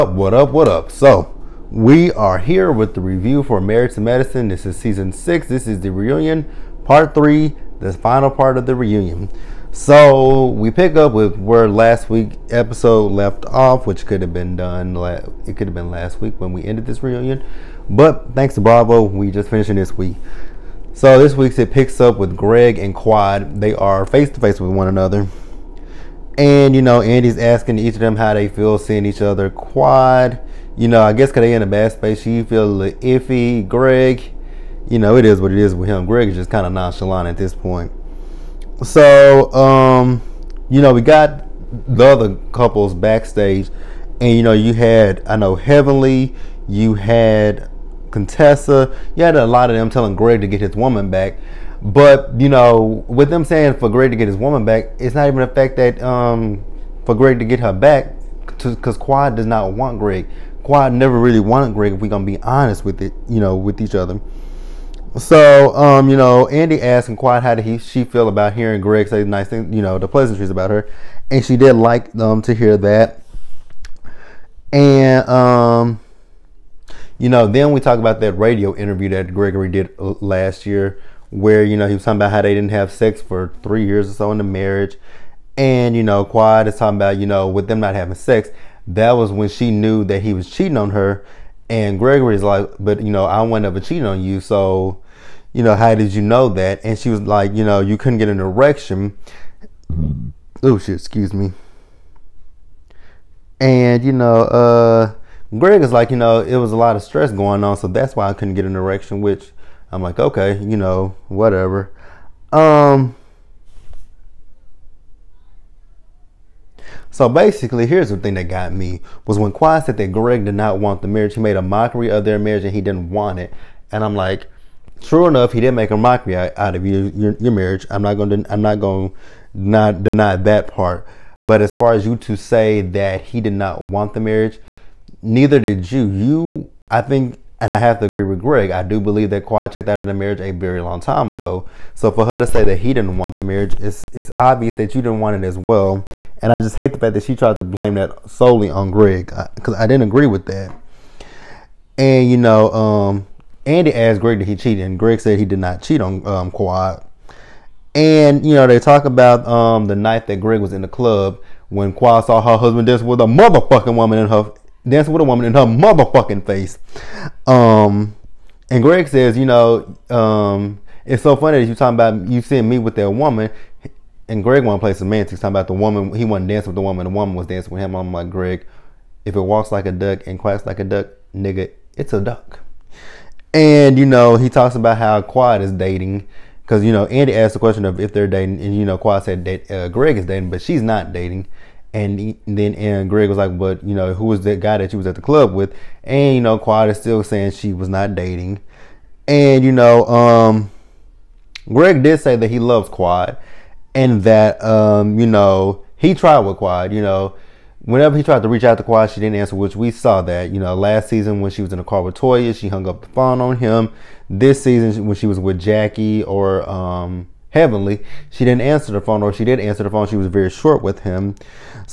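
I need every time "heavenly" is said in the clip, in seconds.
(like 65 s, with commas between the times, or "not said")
45 s, 217 s.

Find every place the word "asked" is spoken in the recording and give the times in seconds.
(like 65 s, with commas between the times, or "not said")
66 s, 153 s, 187 s.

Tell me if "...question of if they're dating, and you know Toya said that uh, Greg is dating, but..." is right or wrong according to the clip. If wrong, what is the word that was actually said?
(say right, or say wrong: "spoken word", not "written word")
wrong: "Quad", not "Toya".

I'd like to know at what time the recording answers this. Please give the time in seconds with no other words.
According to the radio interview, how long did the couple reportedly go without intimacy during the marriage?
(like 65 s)
83 s.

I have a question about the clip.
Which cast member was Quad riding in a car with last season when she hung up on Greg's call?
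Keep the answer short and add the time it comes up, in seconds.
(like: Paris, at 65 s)
Toya, at 212 s.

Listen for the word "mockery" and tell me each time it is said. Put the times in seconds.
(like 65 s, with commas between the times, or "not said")
121 s, 125 s.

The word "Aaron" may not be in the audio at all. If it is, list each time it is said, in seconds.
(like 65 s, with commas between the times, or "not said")
192 s.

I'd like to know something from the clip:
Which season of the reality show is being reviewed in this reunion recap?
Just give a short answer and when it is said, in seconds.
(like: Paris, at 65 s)
6, at 4 s.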